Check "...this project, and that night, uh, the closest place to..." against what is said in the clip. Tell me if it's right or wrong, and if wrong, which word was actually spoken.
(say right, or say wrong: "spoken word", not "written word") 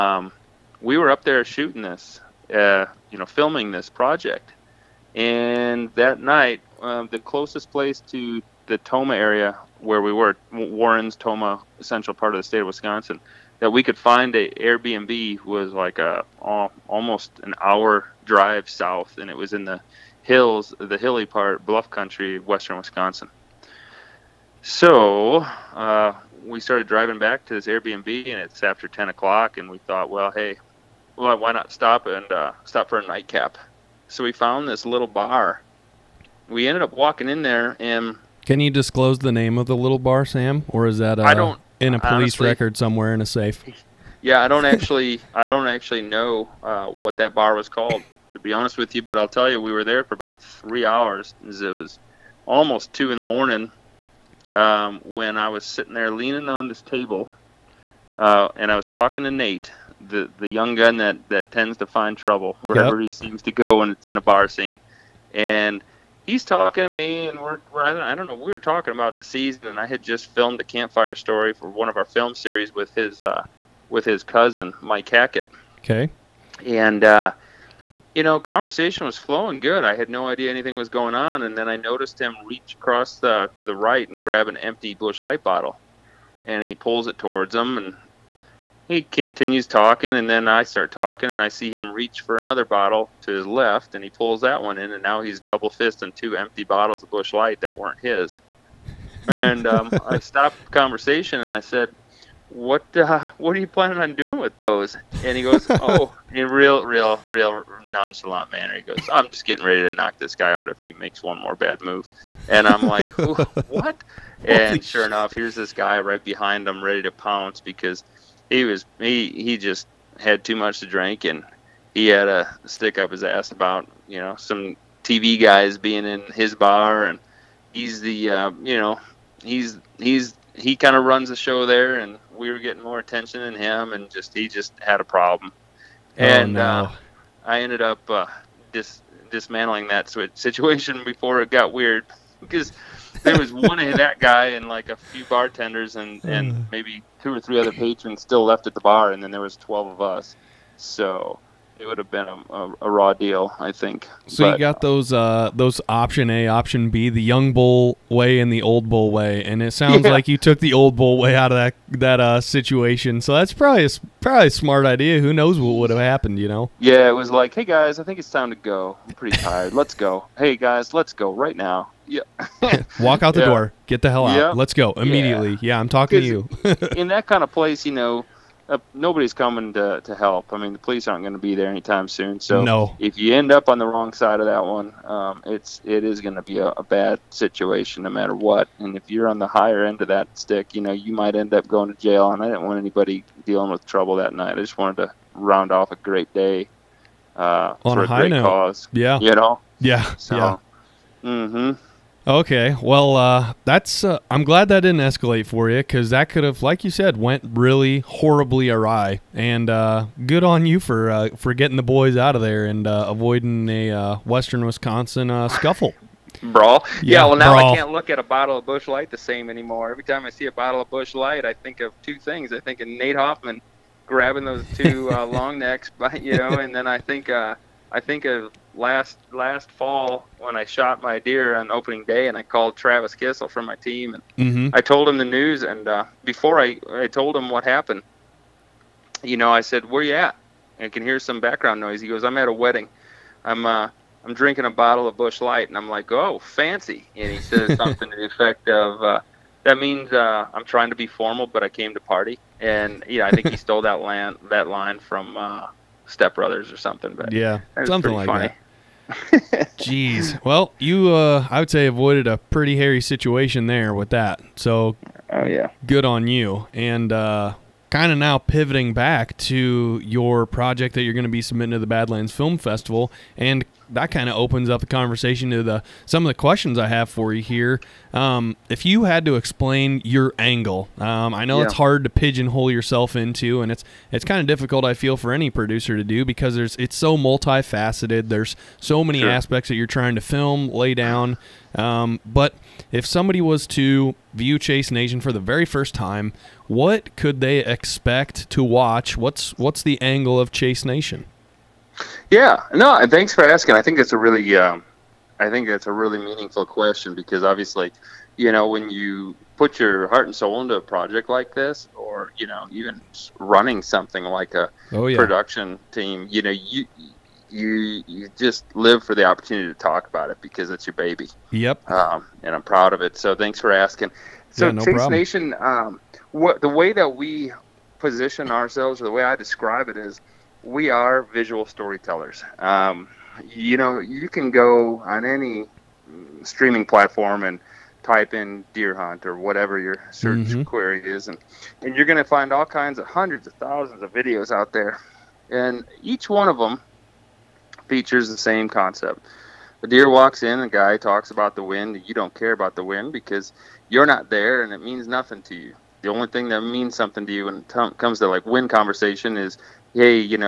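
right.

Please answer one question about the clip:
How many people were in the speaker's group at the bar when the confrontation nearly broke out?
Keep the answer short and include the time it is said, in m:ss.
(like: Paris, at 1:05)
12, at 2:29.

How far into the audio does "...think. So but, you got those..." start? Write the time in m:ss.
2:33.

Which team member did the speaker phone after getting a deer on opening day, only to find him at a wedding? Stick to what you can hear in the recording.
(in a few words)
Travis Kissel.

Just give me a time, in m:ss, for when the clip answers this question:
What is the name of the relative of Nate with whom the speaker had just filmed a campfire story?
1:14.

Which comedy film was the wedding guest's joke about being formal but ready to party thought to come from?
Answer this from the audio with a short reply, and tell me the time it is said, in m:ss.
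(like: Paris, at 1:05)
Step Brothers, at 4:16.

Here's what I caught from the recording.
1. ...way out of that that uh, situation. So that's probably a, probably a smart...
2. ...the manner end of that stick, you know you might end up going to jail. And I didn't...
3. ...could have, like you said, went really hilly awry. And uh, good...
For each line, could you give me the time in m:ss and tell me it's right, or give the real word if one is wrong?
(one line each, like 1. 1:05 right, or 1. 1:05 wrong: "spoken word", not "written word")
1. 2:41 right
2. 3:09 wrong: "higher", not "manner"
3. 3:26 wrong: "horribly", not "hilly".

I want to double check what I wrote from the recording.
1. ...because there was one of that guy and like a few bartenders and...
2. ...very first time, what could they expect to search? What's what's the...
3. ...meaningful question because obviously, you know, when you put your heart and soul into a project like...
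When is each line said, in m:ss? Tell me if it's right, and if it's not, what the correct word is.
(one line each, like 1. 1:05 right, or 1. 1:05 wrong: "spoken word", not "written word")
1. 2:22 right
2. 4:55 wrong: "watch", not "search"
3. 5:06 right.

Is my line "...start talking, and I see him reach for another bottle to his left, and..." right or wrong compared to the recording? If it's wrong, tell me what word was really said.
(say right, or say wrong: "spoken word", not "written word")
right.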